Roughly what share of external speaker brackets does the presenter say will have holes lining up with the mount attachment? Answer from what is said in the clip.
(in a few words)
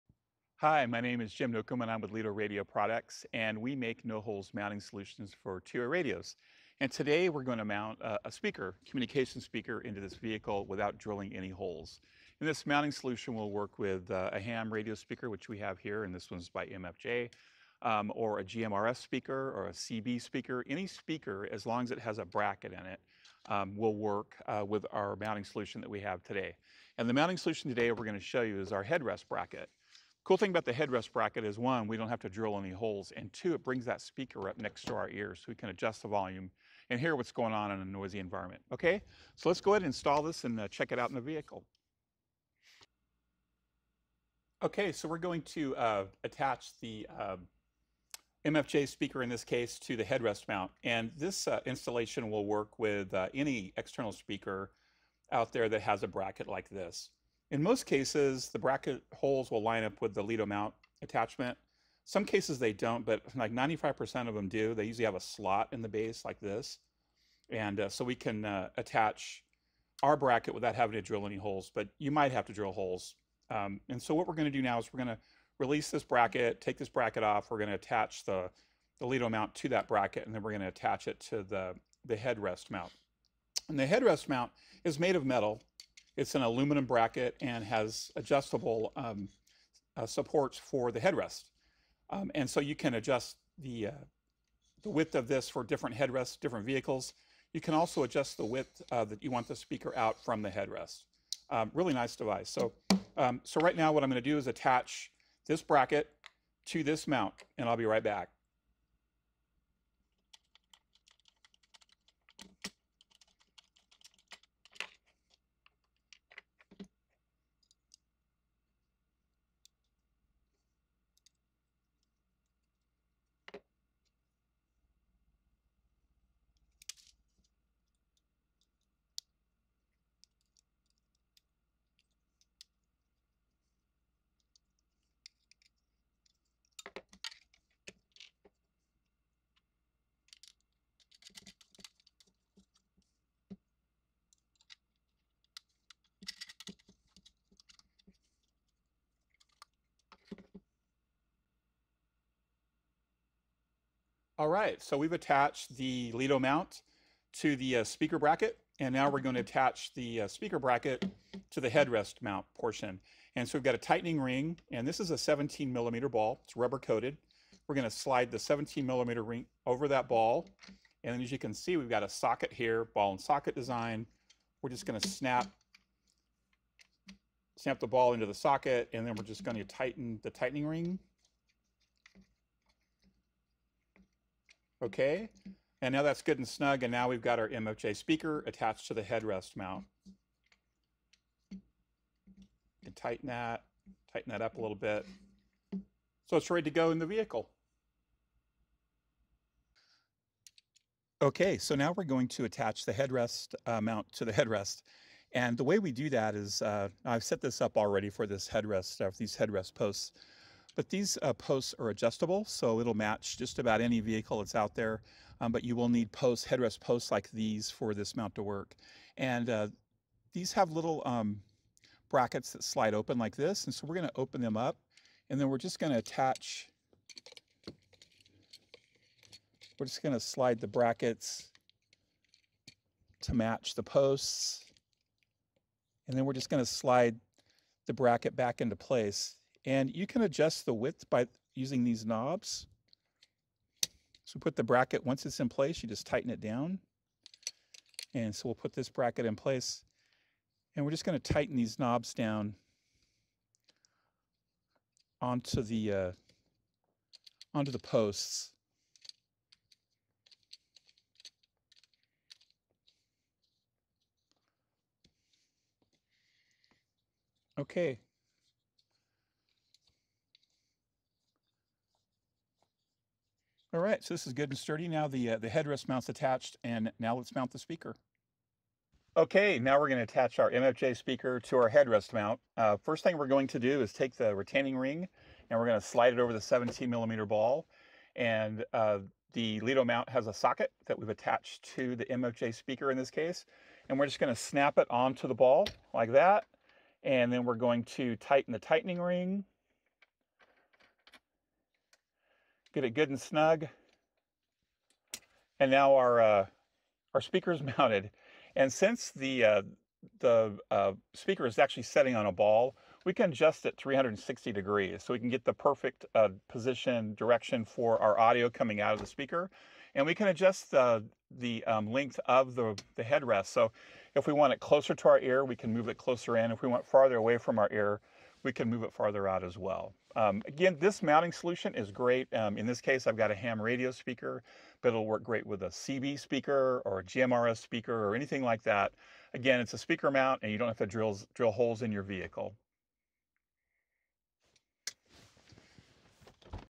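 95%.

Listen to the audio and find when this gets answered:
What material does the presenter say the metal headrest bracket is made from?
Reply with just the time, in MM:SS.
01:26.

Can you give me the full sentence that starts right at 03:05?
And now that's good and snug, and now we've got our MFJ speaker attached to the headrest mount.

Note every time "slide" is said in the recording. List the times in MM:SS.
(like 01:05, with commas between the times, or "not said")
02:47, 03:42, 03:50, 03:56, 04:45.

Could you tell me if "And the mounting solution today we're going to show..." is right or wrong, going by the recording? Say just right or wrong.
right.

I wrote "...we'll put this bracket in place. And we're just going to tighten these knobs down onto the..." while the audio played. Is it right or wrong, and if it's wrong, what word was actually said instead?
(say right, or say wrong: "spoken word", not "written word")
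right.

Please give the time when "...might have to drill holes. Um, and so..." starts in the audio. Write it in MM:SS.
01:12.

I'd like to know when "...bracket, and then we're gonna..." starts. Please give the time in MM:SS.
01:19.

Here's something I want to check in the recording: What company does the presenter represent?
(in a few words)
Lido Radio Products.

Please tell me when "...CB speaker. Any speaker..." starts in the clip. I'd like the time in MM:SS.
00:19.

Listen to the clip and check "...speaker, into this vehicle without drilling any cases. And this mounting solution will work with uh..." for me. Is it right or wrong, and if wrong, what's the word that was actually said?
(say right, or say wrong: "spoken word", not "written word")
wrong: "holes", not "cases".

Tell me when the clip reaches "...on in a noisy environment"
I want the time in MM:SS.
00:37.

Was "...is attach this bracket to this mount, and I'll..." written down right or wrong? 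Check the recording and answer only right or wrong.
right.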